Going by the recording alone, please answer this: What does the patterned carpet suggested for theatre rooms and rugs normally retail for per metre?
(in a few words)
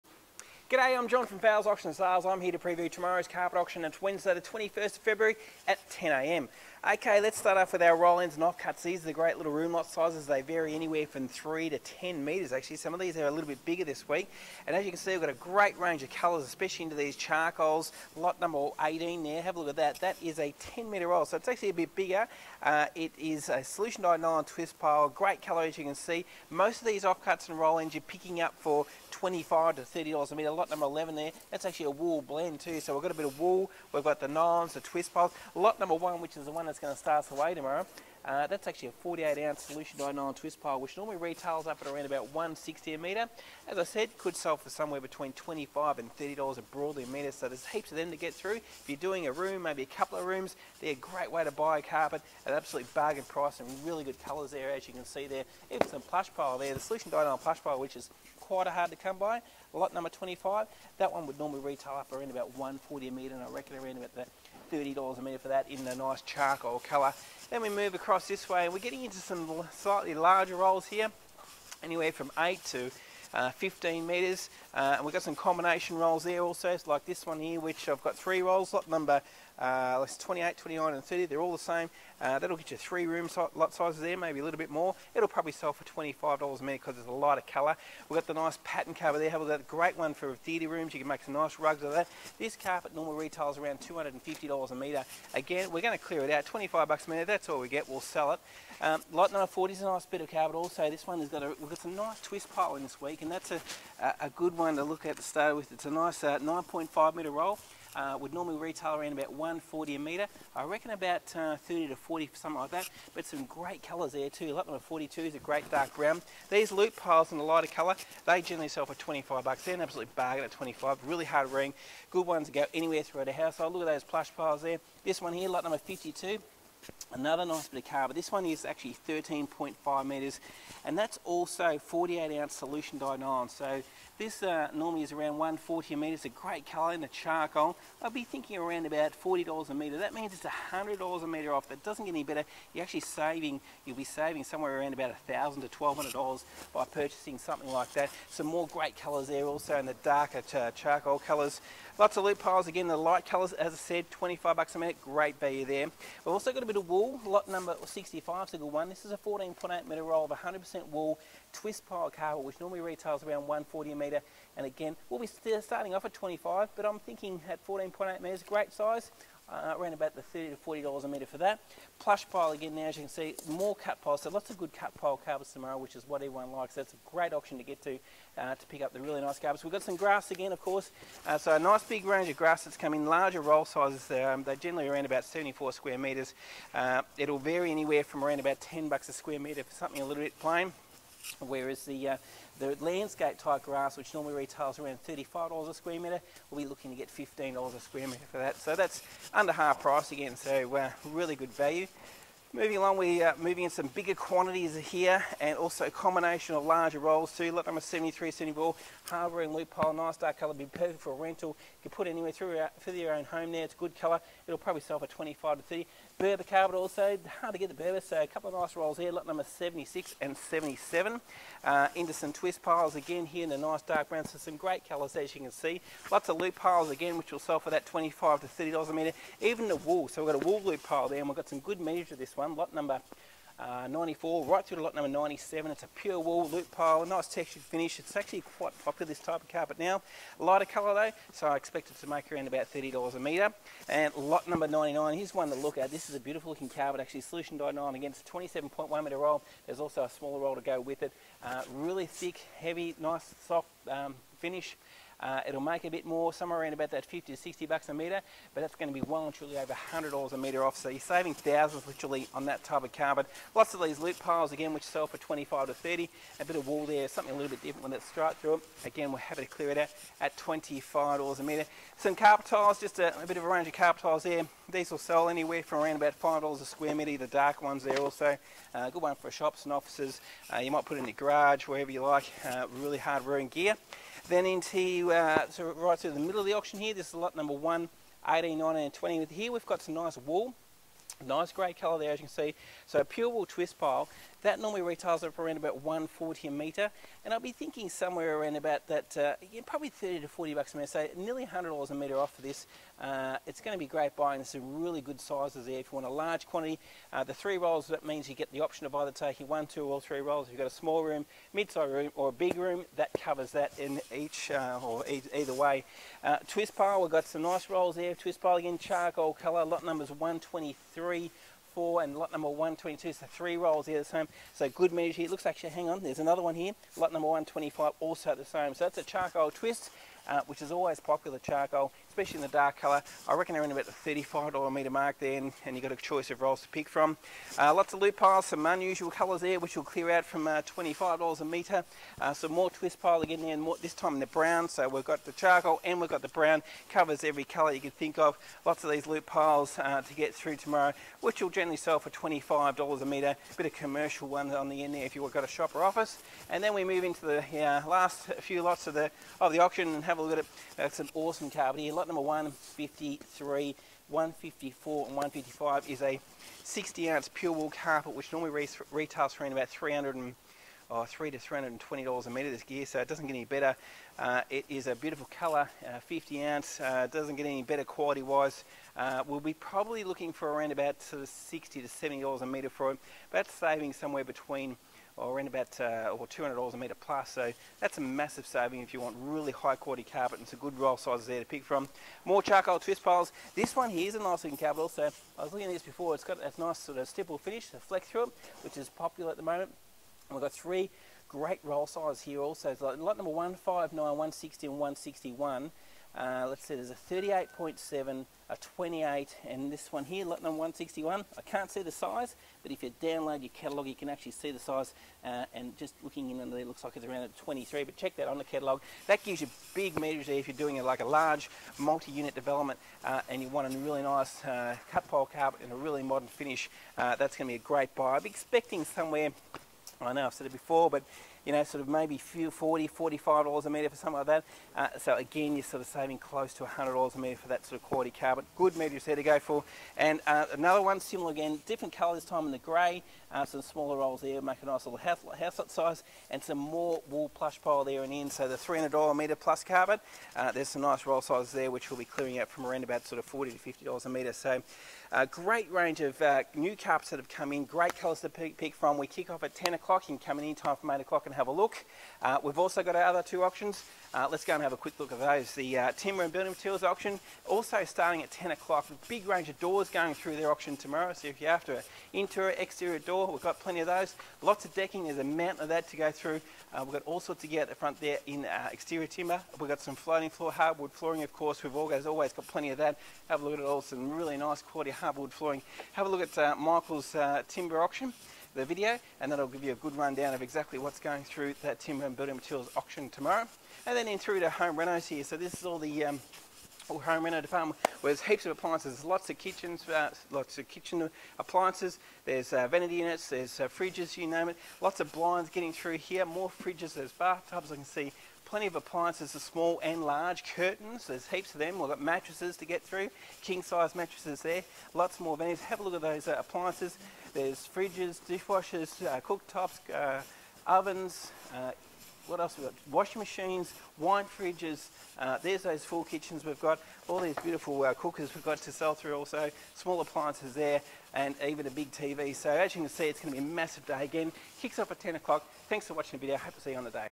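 $250.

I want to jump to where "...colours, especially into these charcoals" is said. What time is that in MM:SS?
00:16.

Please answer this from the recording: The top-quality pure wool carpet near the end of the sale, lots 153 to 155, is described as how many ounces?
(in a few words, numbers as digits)
60 ounce.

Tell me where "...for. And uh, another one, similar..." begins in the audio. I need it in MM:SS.
07:19.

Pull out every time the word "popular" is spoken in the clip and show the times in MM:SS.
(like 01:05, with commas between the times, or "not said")
03:58, 05:30, 06:38.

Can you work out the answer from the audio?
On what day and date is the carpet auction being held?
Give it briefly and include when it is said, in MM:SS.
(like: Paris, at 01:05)
Wednesday 21 February, at 00:04.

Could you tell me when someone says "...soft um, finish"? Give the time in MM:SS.
04:13.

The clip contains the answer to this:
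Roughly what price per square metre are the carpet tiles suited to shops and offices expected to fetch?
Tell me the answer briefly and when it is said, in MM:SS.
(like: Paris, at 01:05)
$5, at 04:36.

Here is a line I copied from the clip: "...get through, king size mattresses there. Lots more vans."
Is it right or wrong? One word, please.
right.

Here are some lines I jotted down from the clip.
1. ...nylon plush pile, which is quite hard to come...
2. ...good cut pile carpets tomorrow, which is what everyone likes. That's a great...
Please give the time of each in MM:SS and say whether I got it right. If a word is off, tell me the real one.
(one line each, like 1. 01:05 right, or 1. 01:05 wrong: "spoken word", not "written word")
1. 00:57 right
2. 02:54 right.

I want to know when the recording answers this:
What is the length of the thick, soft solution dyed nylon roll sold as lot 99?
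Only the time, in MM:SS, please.
04:08.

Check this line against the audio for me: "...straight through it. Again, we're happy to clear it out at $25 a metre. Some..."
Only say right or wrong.
right.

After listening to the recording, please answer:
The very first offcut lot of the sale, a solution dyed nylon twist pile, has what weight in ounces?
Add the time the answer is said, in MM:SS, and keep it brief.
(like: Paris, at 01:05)
48 ounce, at 00:38.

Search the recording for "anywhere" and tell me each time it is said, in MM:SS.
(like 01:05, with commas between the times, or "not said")
00:10, 01:11, 02:02, 03:07, 03:32, 04:35.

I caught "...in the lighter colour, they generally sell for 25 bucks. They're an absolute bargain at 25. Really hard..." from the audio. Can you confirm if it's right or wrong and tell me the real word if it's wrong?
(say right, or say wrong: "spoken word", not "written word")
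right.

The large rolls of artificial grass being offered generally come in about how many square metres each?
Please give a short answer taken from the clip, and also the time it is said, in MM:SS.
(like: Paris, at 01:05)
74 square metres, at 03:05.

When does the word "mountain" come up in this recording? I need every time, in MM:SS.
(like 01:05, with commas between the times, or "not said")
07:55.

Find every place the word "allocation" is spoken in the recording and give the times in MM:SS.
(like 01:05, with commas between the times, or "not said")
not said.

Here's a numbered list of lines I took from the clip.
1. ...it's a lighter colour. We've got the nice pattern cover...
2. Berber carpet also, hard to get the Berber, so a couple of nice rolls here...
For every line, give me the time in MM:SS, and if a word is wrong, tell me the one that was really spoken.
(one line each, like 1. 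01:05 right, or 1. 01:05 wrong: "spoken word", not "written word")
1. 01:26 right
2. 03:36 right.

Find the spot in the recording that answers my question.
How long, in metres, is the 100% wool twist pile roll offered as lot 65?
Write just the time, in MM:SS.
02:39.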